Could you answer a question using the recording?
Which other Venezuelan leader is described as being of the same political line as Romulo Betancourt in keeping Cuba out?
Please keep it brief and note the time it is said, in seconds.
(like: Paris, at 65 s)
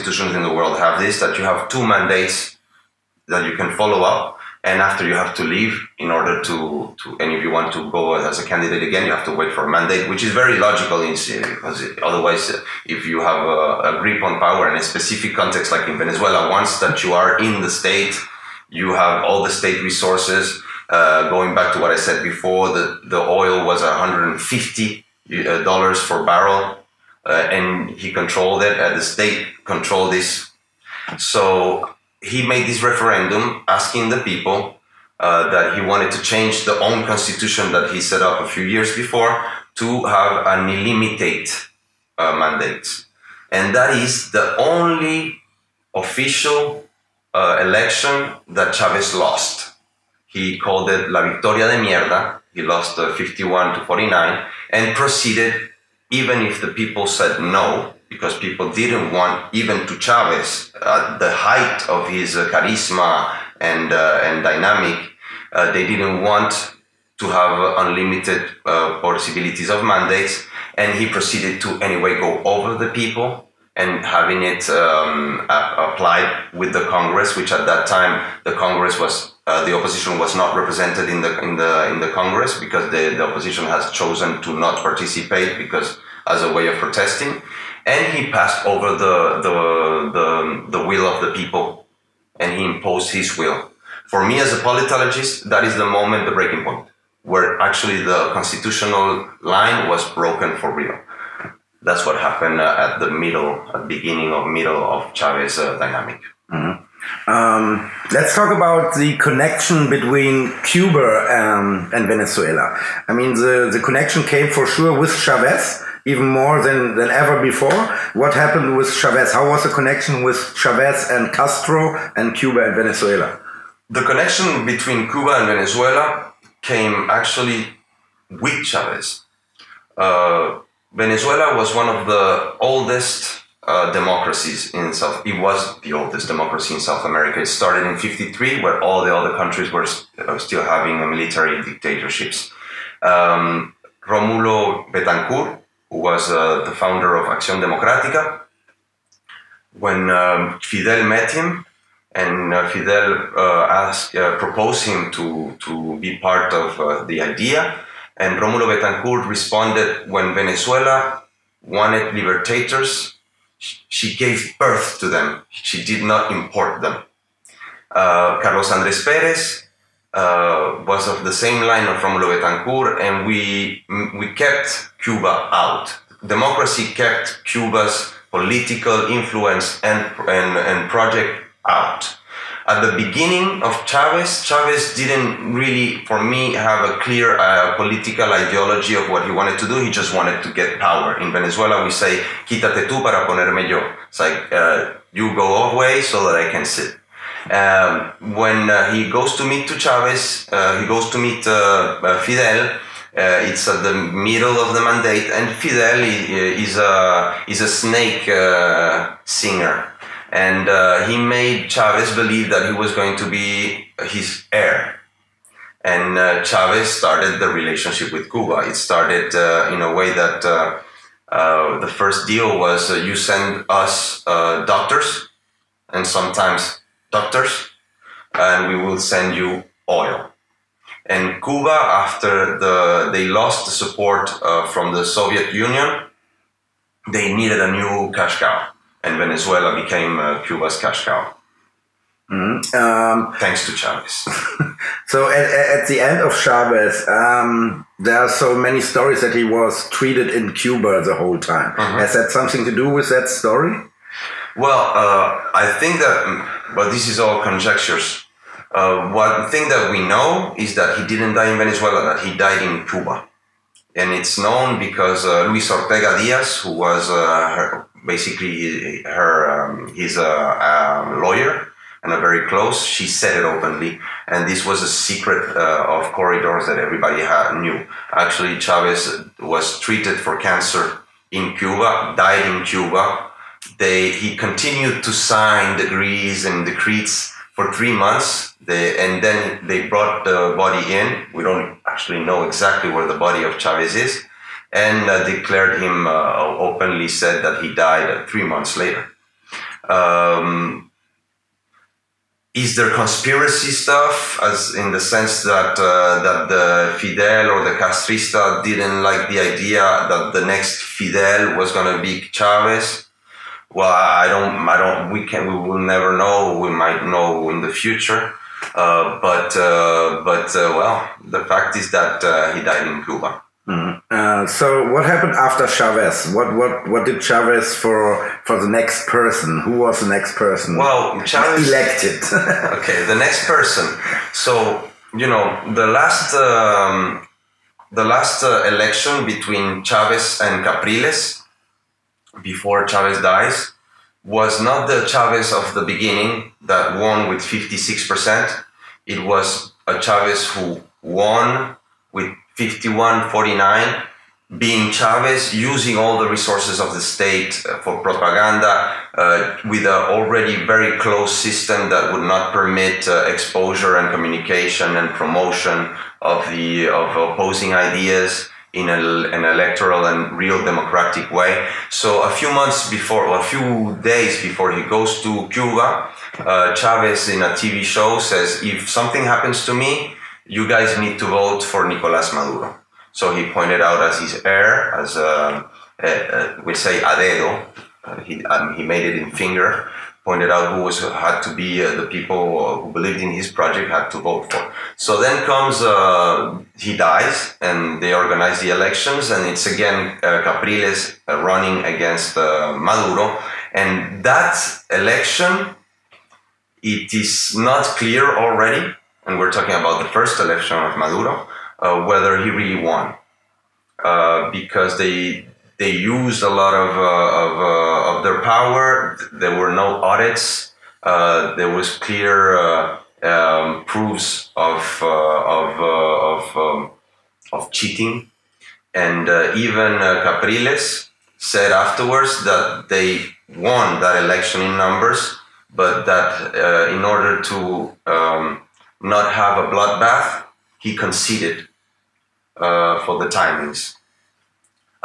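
Carlos Andrés Pérez, at 167 s.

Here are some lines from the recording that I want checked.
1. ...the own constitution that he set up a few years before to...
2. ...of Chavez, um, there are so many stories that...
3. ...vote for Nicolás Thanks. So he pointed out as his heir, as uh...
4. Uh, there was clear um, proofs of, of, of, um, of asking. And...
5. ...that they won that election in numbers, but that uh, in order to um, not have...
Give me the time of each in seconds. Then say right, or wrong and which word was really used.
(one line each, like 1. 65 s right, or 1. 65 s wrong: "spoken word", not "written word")
1. 36 s right
2. 246 s right
3. 381 s wrong: "Maduro", not "Thanks"
4. 421 s wrong: "cheating", not "asking"
5. 432 s right.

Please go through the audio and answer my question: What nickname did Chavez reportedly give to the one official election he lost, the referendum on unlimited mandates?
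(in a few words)
La Victoria de Mierda.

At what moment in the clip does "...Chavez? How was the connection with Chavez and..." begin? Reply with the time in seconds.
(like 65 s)
118 s.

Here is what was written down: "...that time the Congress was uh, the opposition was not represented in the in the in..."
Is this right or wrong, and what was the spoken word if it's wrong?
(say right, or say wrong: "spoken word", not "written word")
right.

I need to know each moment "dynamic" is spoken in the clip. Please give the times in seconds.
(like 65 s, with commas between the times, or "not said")
64 s, 105 s.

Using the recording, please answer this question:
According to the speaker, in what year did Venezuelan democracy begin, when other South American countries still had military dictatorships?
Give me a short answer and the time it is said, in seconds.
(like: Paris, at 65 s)
1953, at 137 s.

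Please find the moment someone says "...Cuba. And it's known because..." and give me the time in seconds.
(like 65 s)
262 s.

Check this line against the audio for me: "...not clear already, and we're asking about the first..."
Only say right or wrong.
wrong.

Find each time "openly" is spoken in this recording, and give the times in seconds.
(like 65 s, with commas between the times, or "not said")
273 s, 296 s.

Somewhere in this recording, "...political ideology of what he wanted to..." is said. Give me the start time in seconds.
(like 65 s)
187 s.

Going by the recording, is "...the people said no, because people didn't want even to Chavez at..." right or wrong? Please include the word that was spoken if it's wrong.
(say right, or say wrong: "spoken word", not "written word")
right.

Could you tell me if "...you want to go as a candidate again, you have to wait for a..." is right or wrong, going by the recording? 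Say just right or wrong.
right.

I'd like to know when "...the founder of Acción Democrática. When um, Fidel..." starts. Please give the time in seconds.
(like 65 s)
146 s.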